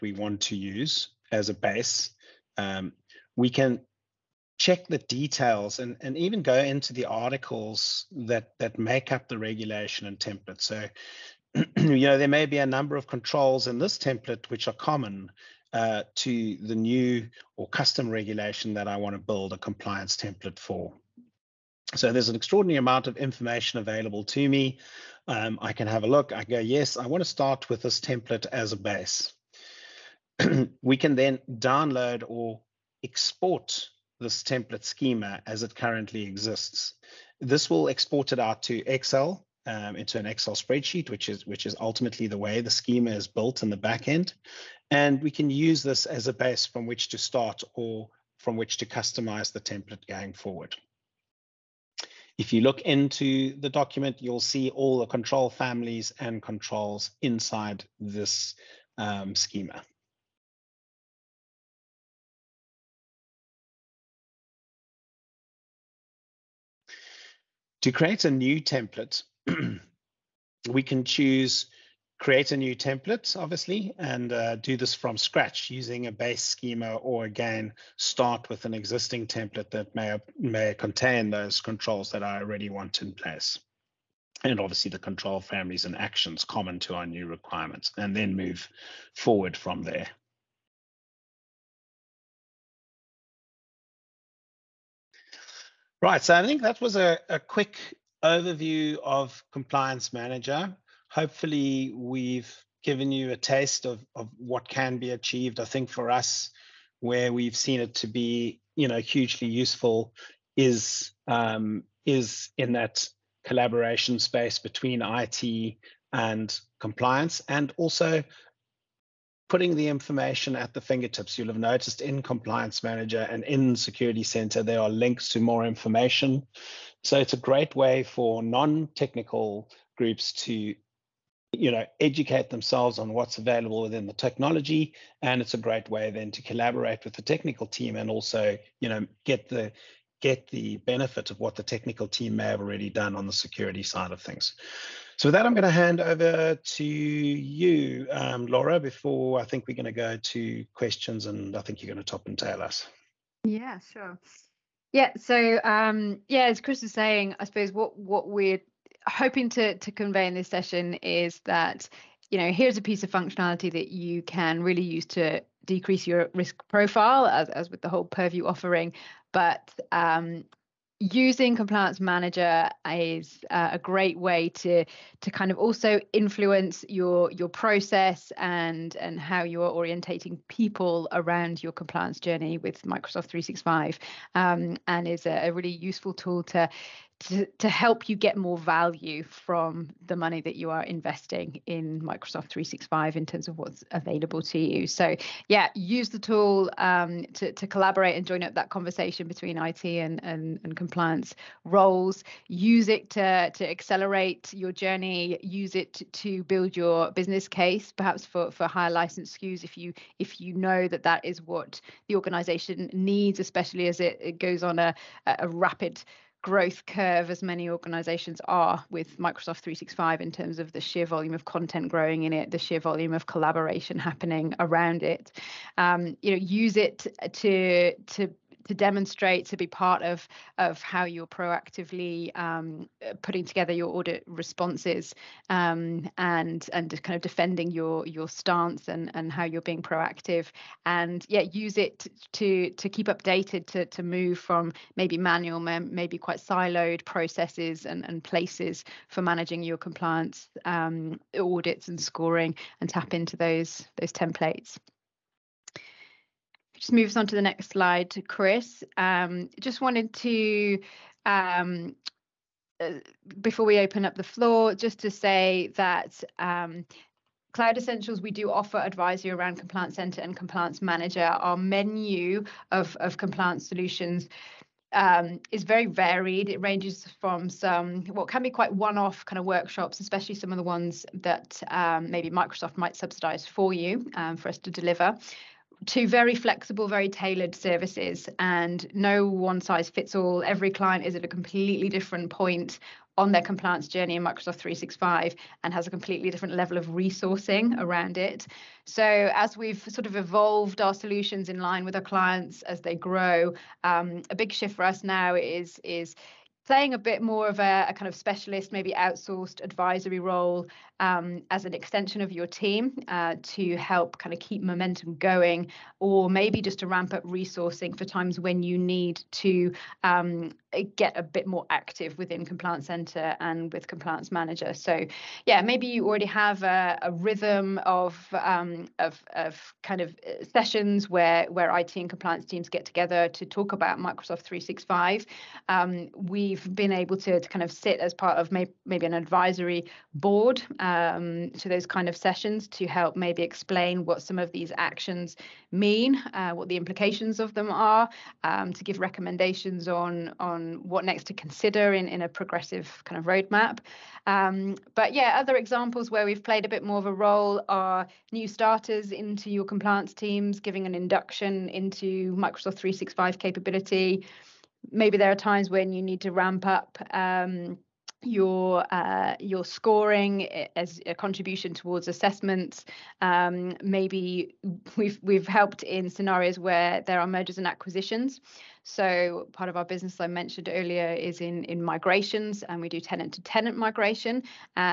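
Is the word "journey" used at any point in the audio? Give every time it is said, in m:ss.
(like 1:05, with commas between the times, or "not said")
3:02, 3:24, 4:53.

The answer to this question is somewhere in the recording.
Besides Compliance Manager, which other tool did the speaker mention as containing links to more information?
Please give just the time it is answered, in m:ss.
2:03.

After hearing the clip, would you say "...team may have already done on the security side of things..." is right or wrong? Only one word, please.
right.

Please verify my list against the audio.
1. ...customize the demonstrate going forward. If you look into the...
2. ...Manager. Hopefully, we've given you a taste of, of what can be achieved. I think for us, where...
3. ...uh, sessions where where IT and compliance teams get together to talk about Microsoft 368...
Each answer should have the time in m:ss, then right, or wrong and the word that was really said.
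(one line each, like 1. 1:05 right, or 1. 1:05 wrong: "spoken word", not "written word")
1. 0:48 wrong: "template", not "demonstrate"
2. 1:40 right
3. 5:30 wrong: "365", not "368".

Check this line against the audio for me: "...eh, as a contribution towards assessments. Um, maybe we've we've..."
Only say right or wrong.
right.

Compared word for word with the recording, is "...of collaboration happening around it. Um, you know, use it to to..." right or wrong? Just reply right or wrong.
right.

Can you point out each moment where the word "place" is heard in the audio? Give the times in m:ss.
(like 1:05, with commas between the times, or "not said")
1:23, 4:08.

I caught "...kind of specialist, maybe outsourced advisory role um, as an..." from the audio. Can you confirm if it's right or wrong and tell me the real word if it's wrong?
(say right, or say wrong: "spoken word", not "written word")
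right.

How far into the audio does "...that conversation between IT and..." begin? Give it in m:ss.
3:18.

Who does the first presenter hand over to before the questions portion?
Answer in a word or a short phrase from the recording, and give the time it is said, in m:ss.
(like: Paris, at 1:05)
Laura, at 2:28.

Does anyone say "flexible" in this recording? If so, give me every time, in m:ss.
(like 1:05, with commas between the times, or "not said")
4:46.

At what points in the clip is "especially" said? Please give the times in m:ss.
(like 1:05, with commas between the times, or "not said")
3:33, 4:39.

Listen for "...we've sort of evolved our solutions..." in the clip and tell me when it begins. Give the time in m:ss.
4:59.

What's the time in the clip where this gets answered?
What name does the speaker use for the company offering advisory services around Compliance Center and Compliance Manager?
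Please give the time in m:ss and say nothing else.
4:27.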